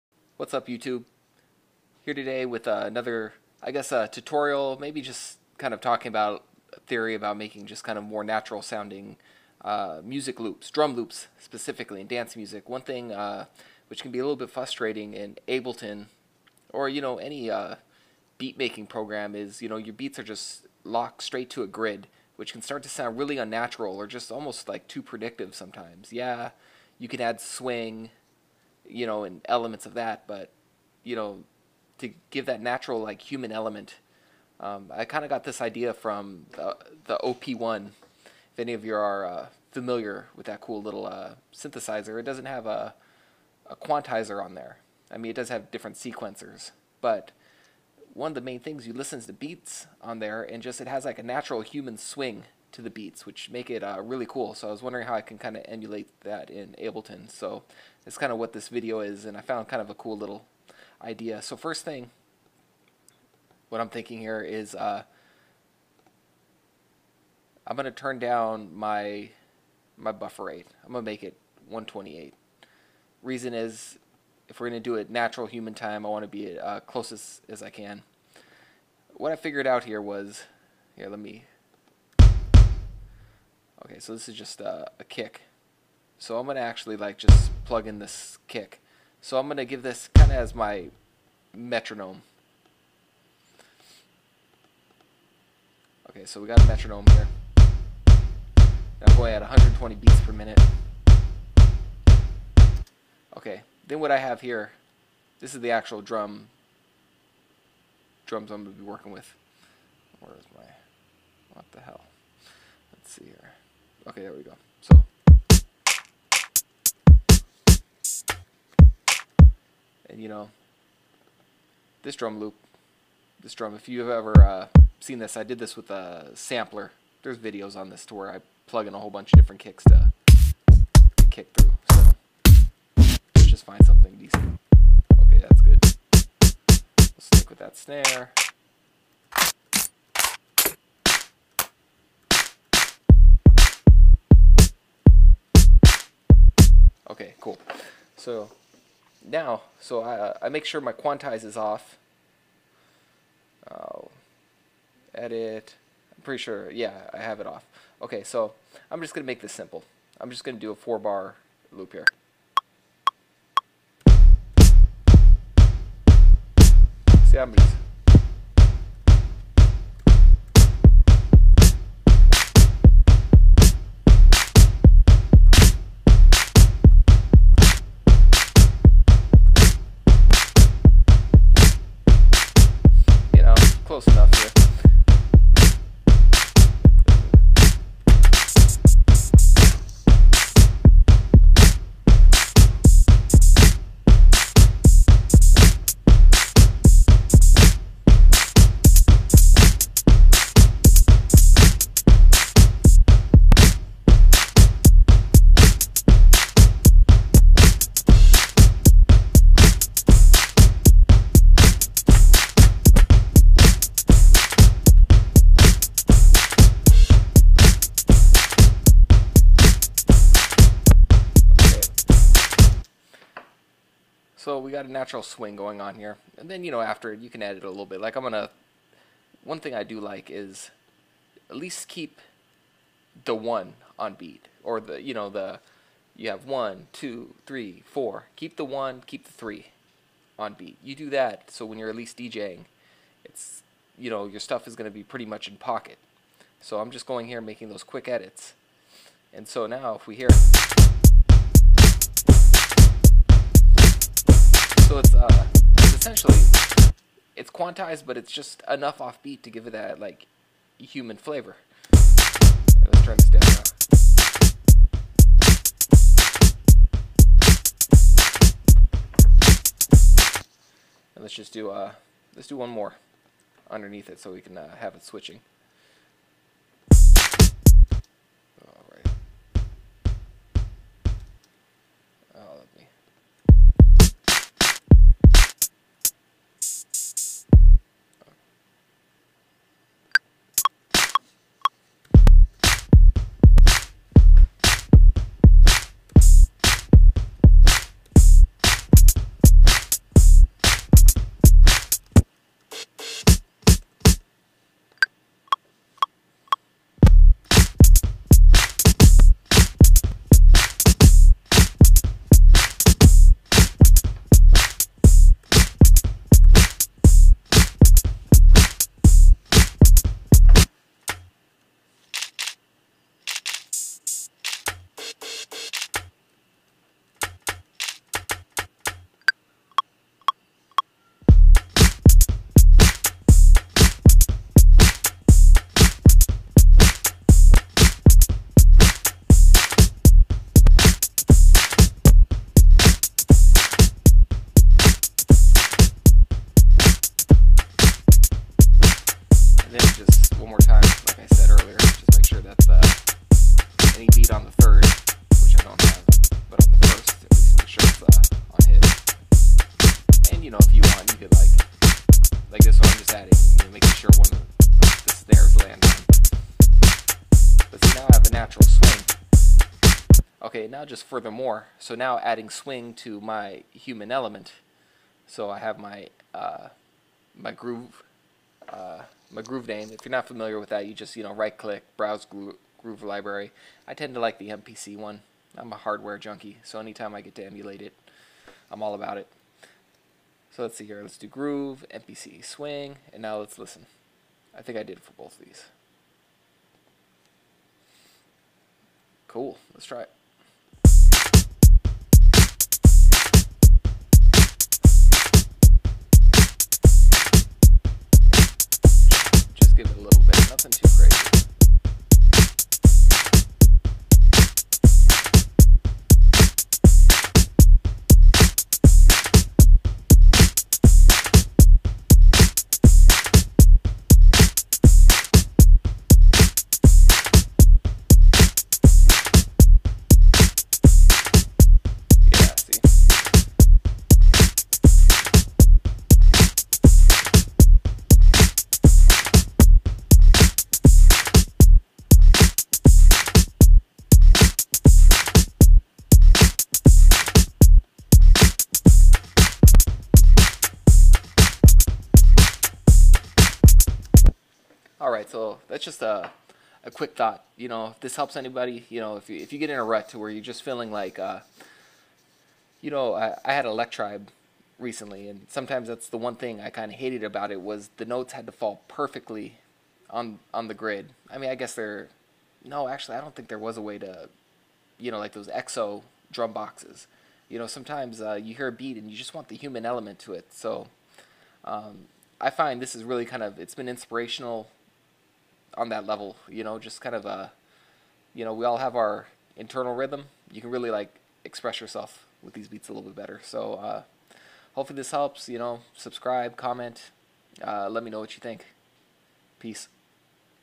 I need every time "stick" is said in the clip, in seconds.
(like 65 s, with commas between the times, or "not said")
137 s.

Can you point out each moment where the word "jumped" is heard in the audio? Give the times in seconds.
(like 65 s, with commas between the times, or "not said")
not said.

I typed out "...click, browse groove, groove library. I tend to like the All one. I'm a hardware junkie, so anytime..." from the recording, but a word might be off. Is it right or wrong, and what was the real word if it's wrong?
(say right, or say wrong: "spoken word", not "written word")
wrong: "MPC", not "All".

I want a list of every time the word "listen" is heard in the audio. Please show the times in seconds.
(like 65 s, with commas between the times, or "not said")
48 s, 393 s.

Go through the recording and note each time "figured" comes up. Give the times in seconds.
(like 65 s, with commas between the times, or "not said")
79 s.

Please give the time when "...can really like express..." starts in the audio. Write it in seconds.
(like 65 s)
490 s.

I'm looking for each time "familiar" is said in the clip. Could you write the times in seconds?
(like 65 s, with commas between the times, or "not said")
39 s, 380 s.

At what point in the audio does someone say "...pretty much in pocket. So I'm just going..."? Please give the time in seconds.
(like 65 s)
245 s.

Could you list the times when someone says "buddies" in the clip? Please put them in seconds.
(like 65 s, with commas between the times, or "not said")
not said.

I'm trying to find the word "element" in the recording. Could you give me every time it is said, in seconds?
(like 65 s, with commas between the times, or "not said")
29 s, 33 s, 374 s, 479 s.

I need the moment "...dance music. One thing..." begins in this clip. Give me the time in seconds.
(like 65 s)
12 s.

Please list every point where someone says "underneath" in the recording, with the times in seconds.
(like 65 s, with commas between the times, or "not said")
273 s.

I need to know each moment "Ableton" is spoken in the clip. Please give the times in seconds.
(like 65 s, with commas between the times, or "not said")
15 s, 56 s.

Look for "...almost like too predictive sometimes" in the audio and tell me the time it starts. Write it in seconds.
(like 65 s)
24 s.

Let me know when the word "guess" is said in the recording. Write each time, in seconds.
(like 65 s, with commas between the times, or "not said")
3 s, 471 s.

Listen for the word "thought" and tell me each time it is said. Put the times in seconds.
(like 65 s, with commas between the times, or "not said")
457 s.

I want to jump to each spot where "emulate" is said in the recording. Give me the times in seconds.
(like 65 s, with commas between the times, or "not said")
55 s, 387 s.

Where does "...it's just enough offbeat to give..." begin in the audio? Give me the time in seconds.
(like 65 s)
258 s.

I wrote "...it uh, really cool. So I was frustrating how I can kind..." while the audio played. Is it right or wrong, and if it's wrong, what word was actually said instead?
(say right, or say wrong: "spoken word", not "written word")
wrong: "wondering", not "frustrating".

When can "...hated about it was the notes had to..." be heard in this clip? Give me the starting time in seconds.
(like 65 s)
466 s.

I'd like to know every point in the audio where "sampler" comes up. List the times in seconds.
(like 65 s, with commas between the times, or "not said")
126 s.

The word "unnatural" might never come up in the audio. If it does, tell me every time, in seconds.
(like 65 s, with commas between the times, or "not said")
23 s.